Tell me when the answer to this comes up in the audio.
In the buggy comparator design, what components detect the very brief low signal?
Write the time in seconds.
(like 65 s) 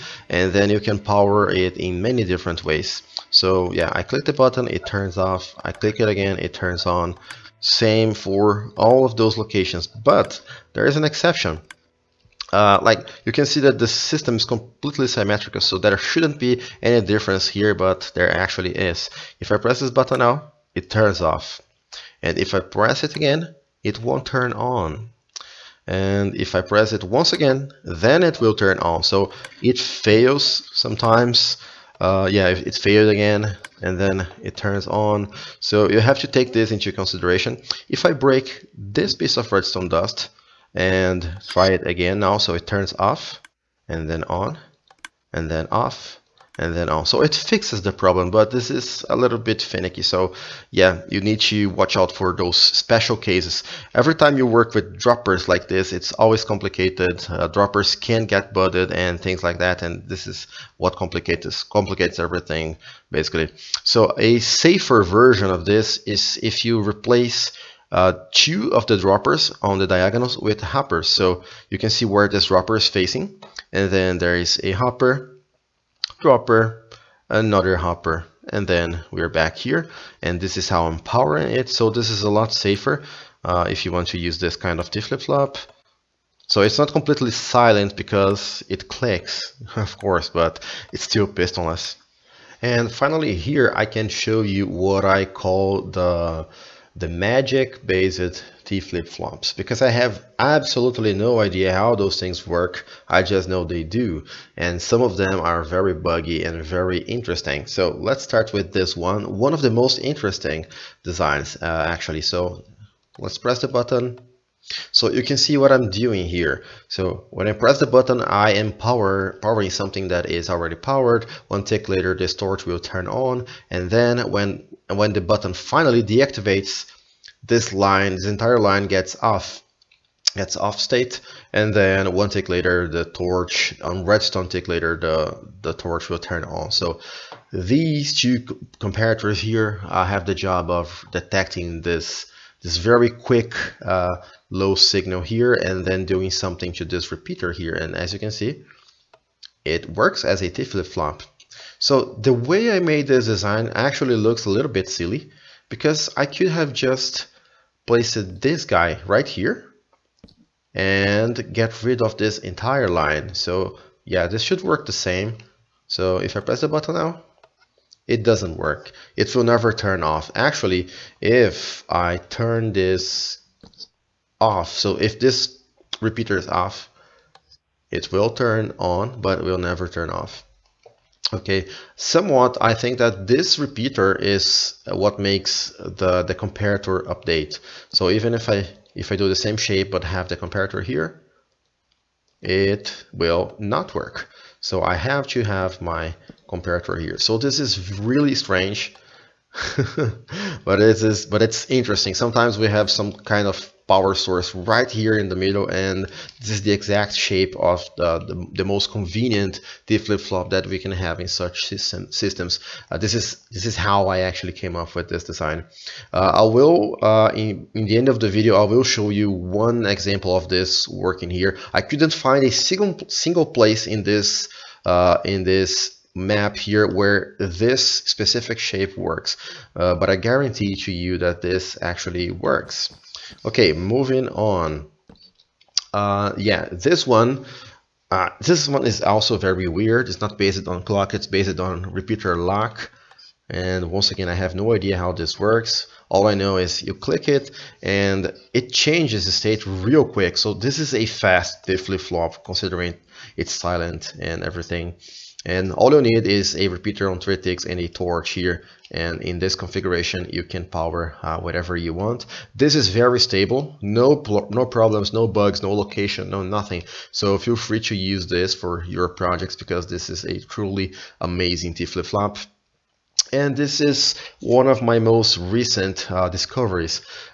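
138 s.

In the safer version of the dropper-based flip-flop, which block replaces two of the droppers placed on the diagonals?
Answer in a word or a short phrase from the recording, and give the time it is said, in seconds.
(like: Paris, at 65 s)
Hoppers, at 70 s.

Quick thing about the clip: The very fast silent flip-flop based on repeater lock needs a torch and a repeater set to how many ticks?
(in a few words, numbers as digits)
3.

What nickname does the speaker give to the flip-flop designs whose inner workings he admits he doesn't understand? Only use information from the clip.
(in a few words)
Magic based T flip-flops.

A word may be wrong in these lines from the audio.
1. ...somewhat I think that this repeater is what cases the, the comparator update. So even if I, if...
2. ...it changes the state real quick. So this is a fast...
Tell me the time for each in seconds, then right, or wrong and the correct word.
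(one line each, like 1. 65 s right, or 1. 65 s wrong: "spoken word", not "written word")
1. 181 s wrong: "makes", not "cases"
2. 248 s right.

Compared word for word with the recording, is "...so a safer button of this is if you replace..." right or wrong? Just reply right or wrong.
wrong.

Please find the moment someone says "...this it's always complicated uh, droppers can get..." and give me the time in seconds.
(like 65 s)
55 s.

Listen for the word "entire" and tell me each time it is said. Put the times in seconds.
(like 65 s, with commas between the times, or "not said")
128 s, 162 s.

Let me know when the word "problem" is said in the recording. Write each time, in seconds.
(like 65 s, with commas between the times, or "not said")
47 s, 264 s.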